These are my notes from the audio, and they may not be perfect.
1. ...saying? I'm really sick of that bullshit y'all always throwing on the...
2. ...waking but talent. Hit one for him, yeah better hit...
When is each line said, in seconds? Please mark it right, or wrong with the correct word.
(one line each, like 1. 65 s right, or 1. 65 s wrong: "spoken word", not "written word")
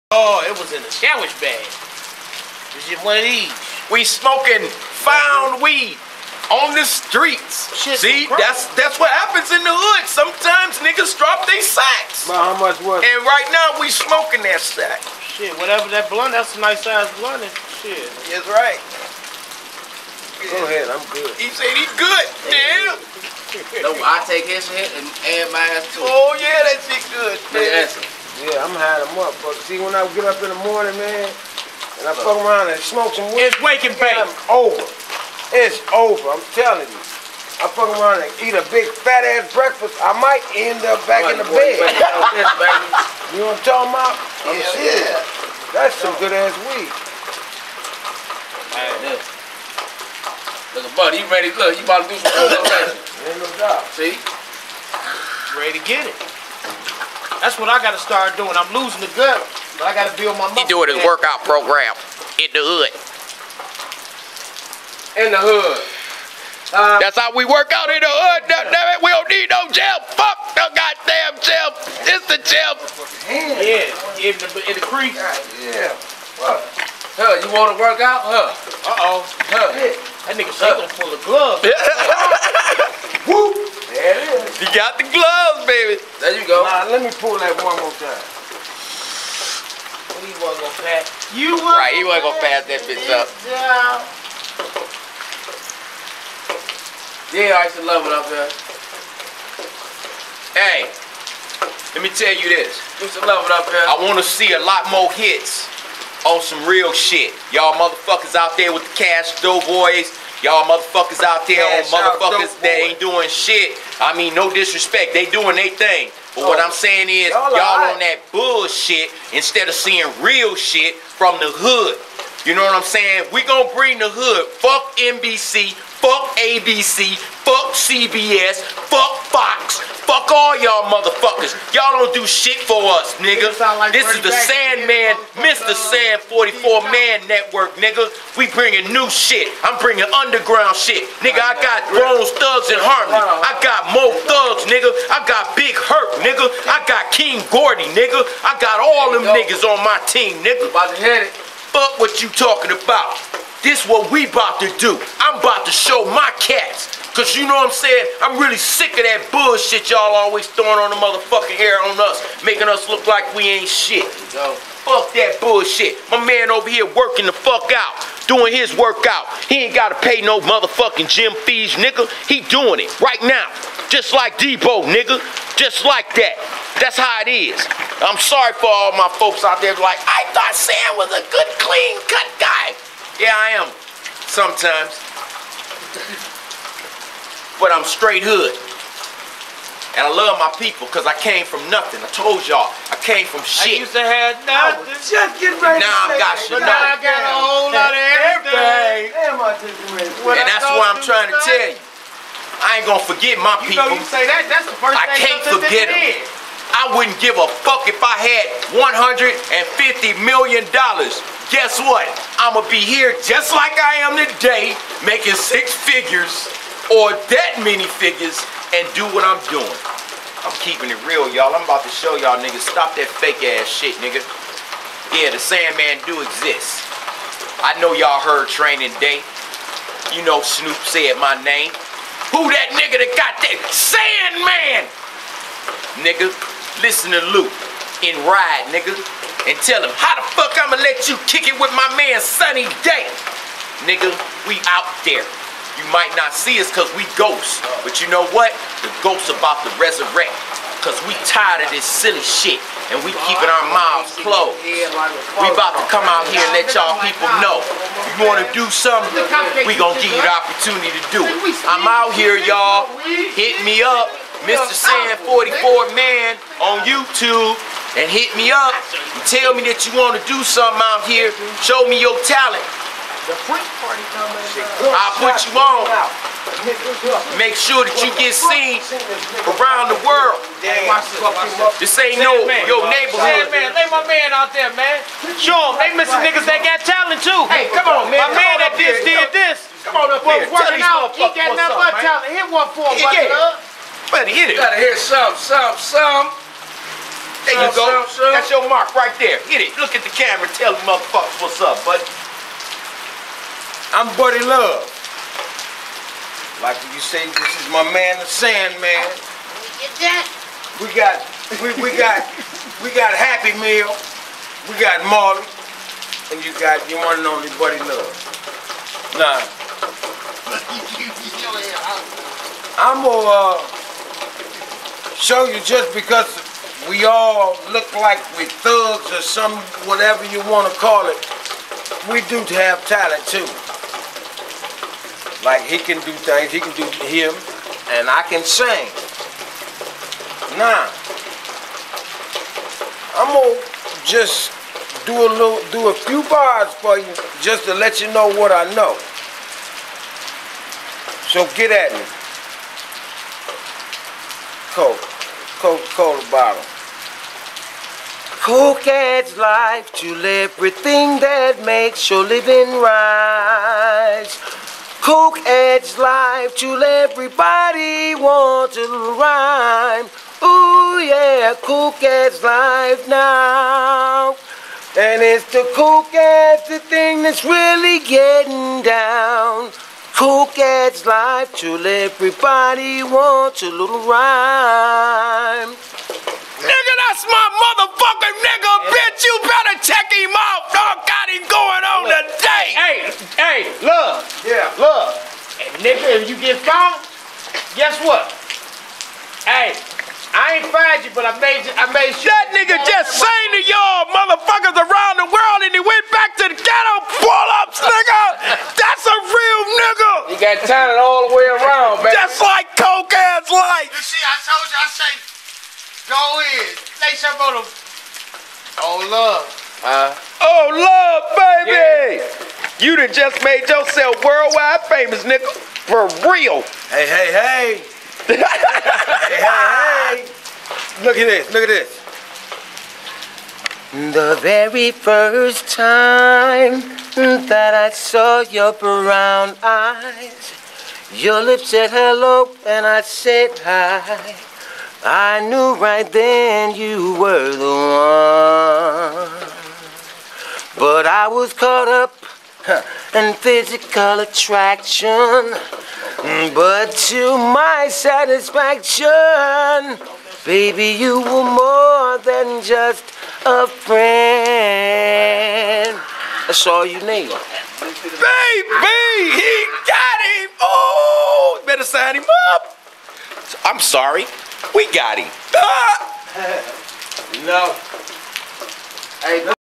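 1. 157 s right
2. 291 s wrong: "nothing", not "waking".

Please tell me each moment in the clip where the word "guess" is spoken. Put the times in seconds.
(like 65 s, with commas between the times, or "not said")
210 s, 397 s.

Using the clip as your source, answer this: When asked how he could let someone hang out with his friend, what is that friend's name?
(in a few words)
Sunny Day.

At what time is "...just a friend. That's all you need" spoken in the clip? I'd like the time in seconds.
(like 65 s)
462 s.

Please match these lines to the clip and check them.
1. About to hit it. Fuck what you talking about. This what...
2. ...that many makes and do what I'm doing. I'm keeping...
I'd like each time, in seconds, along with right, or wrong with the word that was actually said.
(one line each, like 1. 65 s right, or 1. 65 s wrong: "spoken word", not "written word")
1. 150 s right
2. 217 s wrong: "figures", not "makes".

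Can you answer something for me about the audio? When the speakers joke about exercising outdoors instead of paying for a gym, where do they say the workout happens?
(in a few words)
In the creek.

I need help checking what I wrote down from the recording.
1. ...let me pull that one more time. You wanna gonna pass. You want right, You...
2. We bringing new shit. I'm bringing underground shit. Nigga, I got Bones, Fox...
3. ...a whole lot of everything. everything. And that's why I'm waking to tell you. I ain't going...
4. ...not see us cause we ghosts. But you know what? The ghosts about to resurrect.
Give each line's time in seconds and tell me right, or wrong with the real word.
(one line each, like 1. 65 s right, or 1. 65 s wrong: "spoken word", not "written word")
1. 86 s right
2. 138 s wrong: "Thugs", not "Fox"
3. 197 s wrong: "trying", not "waking"
4. 246 s right.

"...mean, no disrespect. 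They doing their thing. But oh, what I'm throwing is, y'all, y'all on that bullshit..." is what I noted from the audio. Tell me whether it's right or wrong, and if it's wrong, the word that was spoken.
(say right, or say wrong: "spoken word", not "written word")
wrong: "saying", not "throwing".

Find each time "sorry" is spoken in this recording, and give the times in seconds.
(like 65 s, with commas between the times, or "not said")
178 s, 473 s.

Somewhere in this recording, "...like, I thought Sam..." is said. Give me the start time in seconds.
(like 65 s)
179 s.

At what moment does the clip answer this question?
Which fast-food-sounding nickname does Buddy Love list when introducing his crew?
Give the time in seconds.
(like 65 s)
313 s.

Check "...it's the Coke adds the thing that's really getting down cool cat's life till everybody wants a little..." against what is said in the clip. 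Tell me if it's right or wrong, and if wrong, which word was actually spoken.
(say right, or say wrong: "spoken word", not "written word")
right.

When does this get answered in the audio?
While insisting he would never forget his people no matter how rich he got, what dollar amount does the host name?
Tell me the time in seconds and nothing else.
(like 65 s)
208 s.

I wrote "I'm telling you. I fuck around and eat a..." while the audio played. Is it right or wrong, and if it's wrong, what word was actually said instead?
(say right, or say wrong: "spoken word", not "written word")
right.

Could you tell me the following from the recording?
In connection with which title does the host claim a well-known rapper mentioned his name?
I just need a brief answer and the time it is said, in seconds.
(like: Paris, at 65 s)
Training Day, at 228 s.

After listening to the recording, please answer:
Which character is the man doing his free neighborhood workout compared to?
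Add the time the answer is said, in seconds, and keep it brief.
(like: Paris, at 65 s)
Debo, at 174 s.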